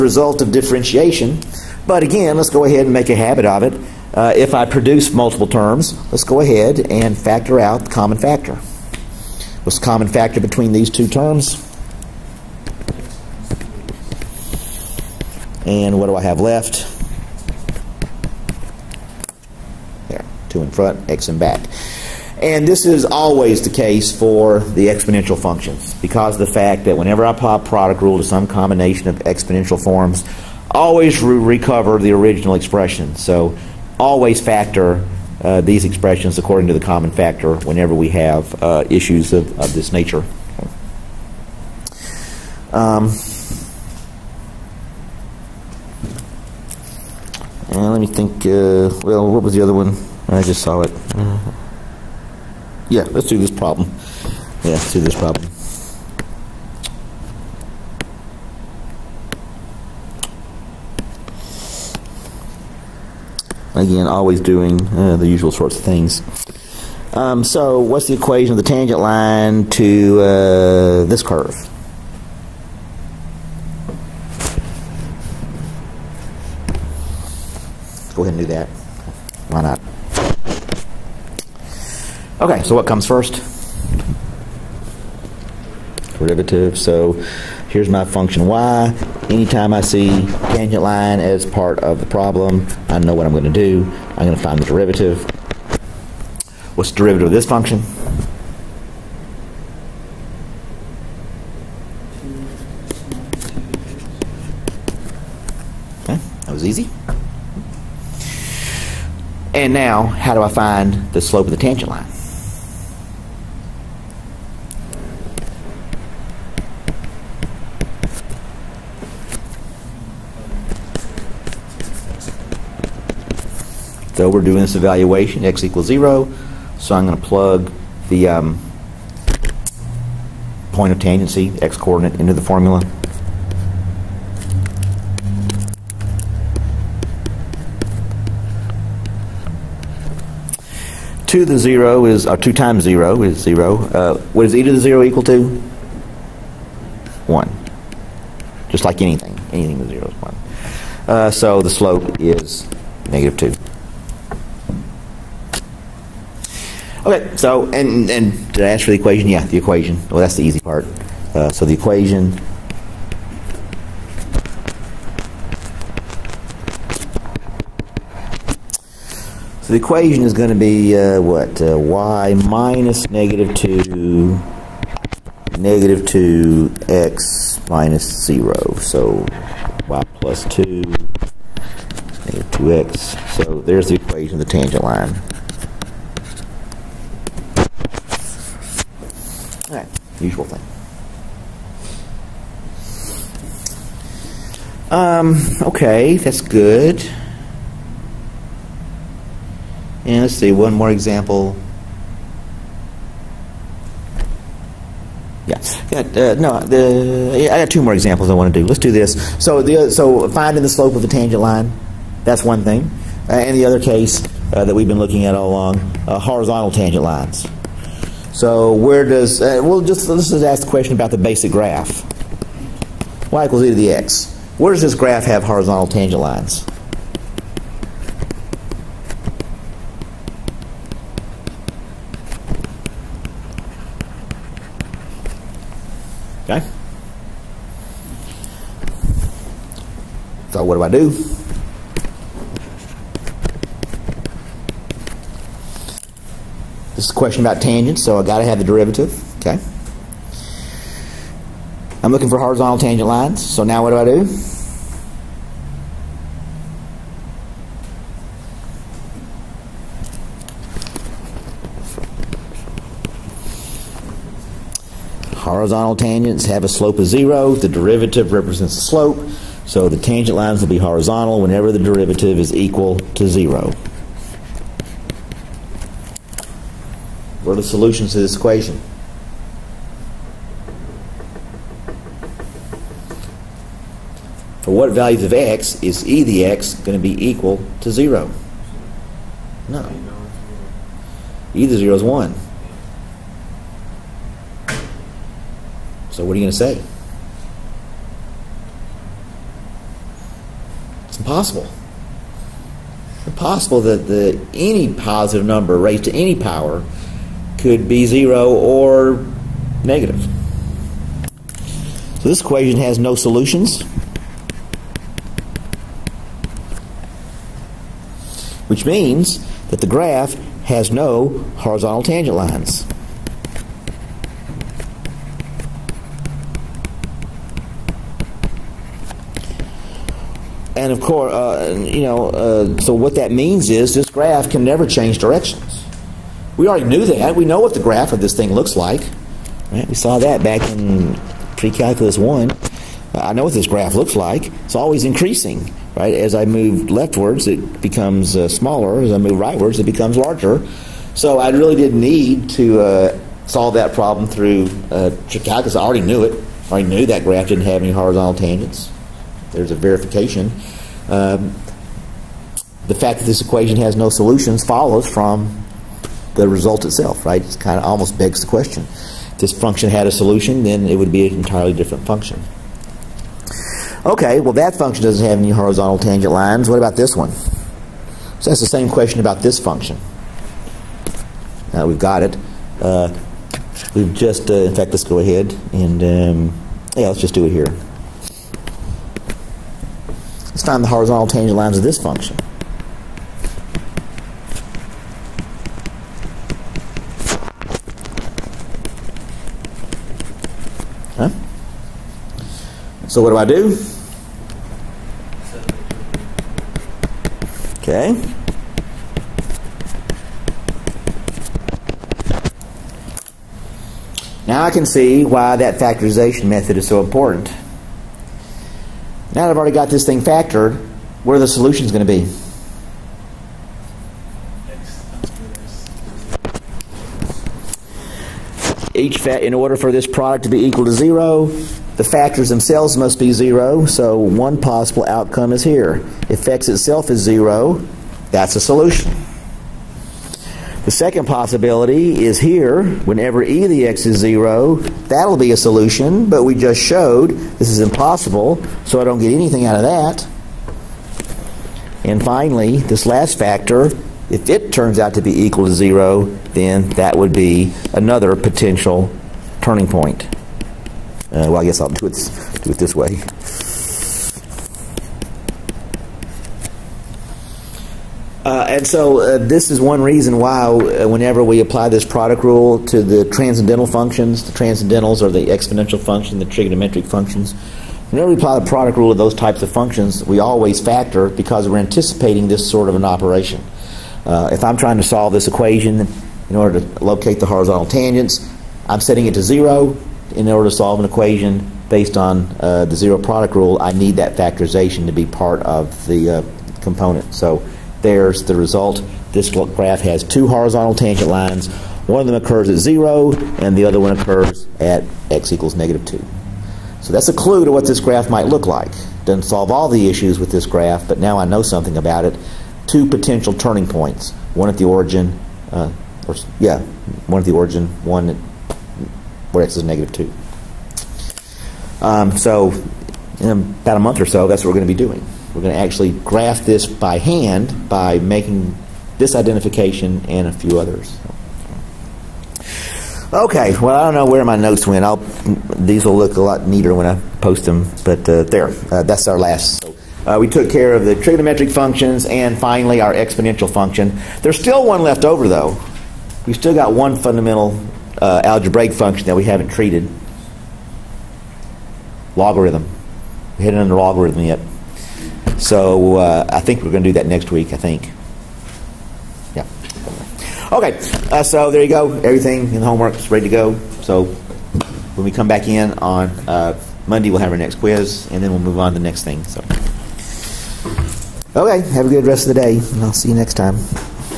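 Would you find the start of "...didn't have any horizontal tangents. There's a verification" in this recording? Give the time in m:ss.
5:57.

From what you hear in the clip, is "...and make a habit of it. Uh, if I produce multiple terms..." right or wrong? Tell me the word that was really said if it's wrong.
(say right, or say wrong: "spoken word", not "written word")
right.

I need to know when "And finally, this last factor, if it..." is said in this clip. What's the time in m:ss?
7:32.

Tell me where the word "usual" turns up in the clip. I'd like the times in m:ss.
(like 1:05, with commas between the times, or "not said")
1:05, 3:10.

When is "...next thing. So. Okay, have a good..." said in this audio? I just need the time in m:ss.
9:29.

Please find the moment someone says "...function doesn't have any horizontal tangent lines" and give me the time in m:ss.
6:14.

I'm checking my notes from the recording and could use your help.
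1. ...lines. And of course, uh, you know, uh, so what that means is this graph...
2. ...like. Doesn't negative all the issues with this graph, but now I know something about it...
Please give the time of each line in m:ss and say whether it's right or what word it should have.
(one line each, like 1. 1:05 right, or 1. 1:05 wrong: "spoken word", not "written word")
1. 5:22 right
2. 8:28 wrong: "solve", not "negative".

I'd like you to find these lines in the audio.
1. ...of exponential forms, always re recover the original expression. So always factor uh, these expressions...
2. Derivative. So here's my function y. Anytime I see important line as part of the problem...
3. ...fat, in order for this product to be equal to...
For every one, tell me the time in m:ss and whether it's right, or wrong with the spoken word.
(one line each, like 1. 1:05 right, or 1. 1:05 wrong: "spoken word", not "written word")
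1. 0:29 right
2. 1:26 wrong: "tangent", not "important"
3. 7:09 right.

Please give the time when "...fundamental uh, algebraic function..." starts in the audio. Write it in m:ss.
9:07.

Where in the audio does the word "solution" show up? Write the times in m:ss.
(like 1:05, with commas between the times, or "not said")
4:37, 5:13, 6:04, 6:10, 7:01, 7:18, 7:25.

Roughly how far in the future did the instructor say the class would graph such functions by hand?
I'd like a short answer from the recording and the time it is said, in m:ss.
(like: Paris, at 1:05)
About a month, at 8:43.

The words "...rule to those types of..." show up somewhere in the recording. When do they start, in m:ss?
7:58.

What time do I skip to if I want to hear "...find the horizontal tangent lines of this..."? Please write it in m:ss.
6:30.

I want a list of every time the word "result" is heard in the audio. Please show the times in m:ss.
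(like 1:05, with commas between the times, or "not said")
6:06, 8:18.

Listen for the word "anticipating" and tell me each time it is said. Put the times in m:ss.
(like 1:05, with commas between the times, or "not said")
8:01.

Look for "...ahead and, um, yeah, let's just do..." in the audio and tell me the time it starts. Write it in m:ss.
6:25.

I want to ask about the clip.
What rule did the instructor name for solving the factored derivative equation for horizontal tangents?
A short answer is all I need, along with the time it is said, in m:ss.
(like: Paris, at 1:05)
Zero product rule, at 8:12.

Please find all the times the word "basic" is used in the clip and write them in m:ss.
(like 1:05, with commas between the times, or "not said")
3:41.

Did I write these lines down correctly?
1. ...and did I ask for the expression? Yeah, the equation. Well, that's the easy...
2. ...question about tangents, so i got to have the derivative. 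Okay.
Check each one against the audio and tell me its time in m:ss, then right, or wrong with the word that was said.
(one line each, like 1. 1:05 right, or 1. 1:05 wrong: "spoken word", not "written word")
1. 2:38 wrong: "equation", not "expression"
2. 4:07 right.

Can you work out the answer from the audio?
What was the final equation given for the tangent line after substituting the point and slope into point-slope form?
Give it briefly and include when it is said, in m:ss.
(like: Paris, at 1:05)
y + 2 = -2x, at 2:59.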